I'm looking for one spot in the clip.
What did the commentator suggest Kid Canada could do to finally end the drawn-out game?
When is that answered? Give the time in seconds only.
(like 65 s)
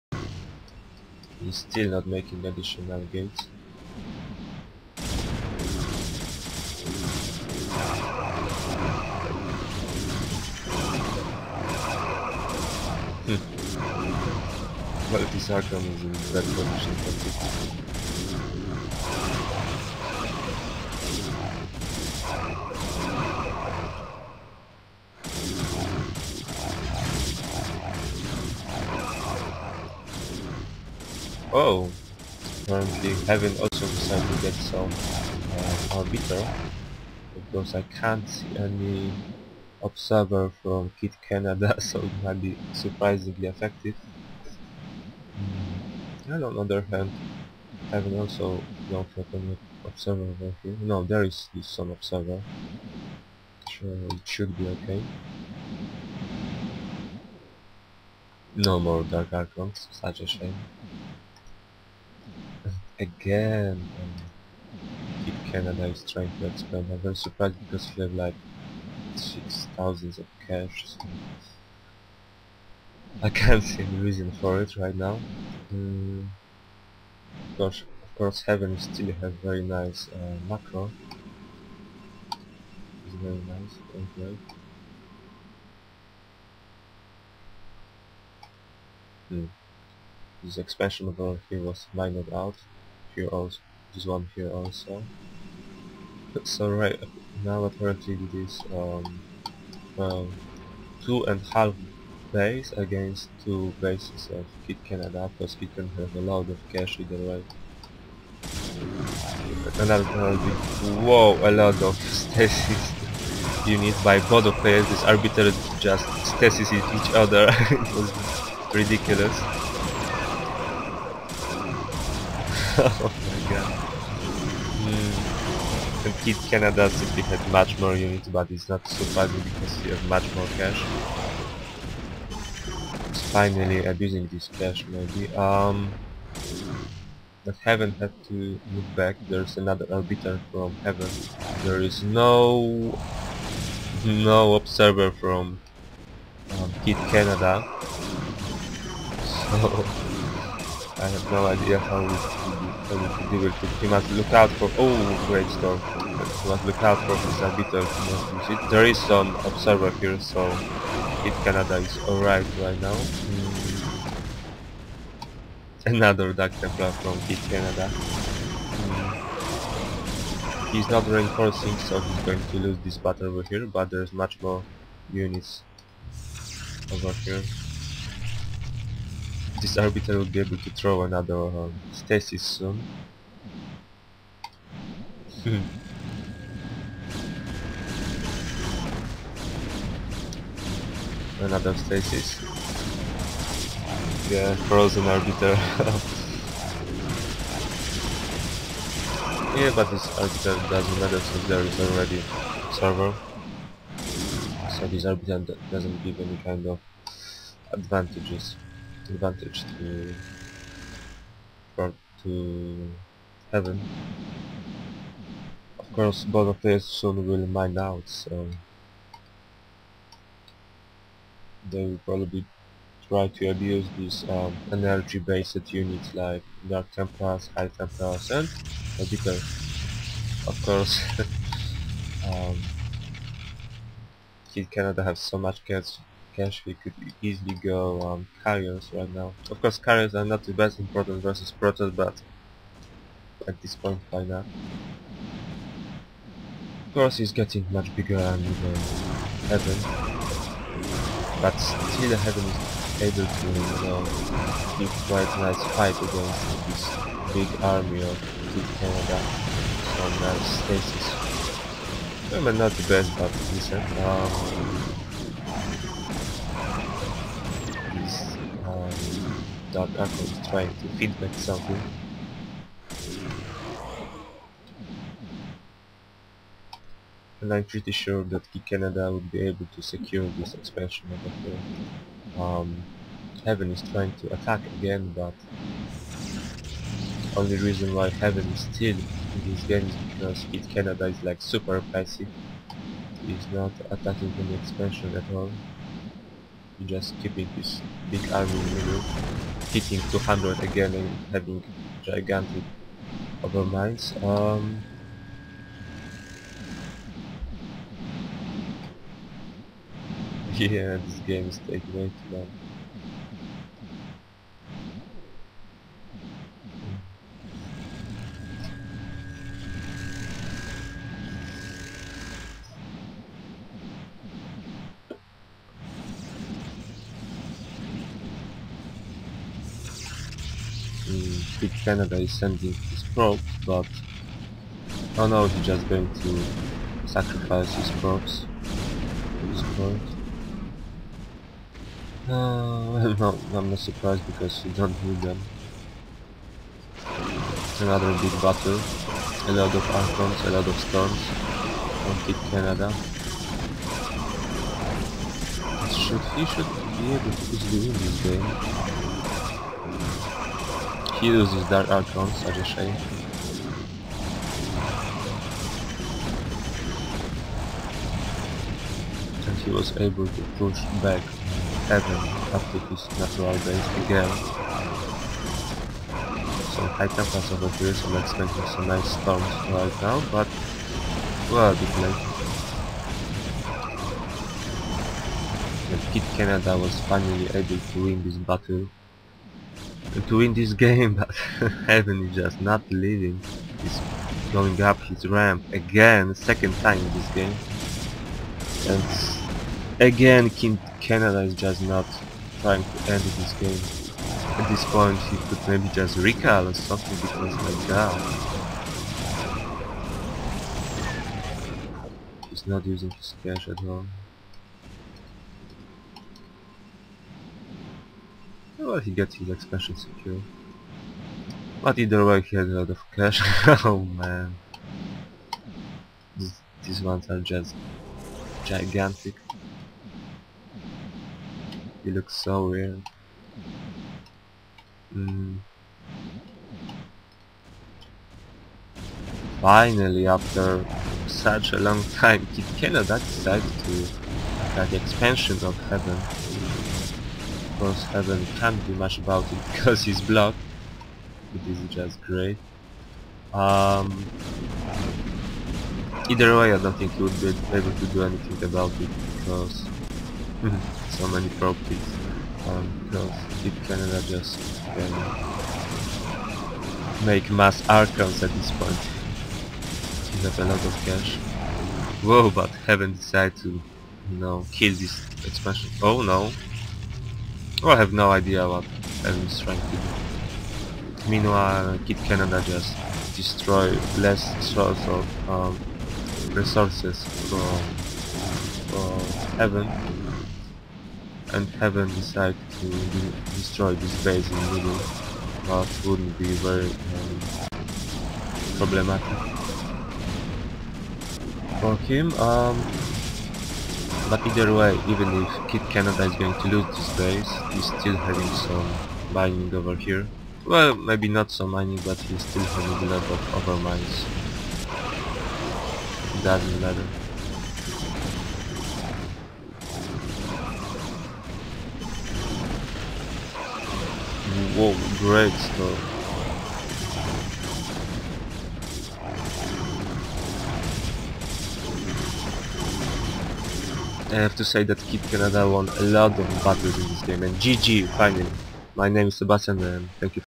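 406 s.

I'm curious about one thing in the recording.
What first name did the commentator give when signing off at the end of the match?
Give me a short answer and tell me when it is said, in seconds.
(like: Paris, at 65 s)
Sebastian, at 539 s.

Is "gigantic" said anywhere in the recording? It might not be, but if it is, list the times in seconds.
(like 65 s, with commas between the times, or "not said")
302 s, 428 s.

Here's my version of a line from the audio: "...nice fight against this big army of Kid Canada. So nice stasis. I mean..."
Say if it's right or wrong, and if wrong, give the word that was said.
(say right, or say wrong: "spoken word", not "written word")
right.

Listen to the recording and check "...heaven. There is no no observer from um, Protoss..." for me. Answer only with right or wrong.
wrong.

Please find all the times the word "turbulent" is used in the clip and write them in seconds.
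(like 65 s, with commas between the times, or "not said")
not said.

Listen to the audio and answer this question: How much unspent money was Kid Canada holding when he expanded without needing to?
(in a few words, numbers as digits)
6000.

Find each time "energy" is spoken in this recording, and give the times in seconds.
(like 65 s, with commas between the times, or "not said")
224 s.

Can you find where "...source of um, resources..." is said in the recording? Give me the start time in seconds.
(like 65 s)
484 s.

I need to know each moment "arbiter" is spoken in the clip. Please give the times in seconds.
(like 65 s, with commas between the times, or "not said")
35 s, 115 s, 139 s, 157 s, 179 s, 195 s, 200 s, 205 s.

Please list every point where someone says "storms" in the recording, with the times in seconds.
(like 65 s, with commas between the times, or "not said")
155 s, 350 s, 379 s.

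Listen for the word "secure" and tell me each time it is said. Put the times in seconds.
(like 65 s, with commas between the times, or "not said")
279 s, 419 s.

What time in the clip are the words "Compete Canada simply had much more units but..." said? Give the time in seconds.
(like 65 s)
126 s.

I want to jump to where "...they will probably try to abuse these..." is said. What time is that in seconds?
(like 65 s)
221 s.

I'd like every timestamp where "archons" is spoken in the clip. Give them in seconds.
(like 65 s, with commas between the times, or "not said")
59 s, 269 s, 350 s, 361 s, 467 s.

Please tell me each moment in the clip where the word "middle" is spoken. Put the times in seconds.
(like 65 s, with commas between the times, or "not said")
298 s, 494 s.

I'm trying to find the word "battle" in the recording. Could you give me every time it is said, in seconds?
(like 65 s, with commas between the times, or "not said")
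172 s, 348 s, 388 s, 536 s.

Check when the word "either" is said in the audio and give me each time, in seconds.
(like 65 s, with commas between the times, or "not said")
106 s, 421 s, 456 s, 504 s.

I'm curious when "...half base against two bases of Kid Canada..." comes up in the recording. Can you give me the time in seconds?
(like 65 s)
101 s.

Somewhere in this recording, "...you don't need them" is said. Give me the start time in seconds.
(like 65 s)
344 s.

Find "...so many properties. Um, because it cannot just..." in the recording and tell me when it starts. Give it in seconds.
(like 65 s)
461 s.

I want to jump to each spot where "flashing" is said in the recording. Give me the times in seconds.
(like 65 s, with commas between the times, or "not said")
not said.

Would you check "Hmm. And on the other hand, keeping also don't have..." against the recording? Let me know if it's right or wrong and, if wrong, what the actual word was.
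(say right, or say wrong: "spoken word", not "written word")
wrong: "having", not "keeping".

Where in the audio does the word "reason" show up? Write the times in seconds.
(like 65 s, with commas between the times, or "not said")
73 s, 287 s.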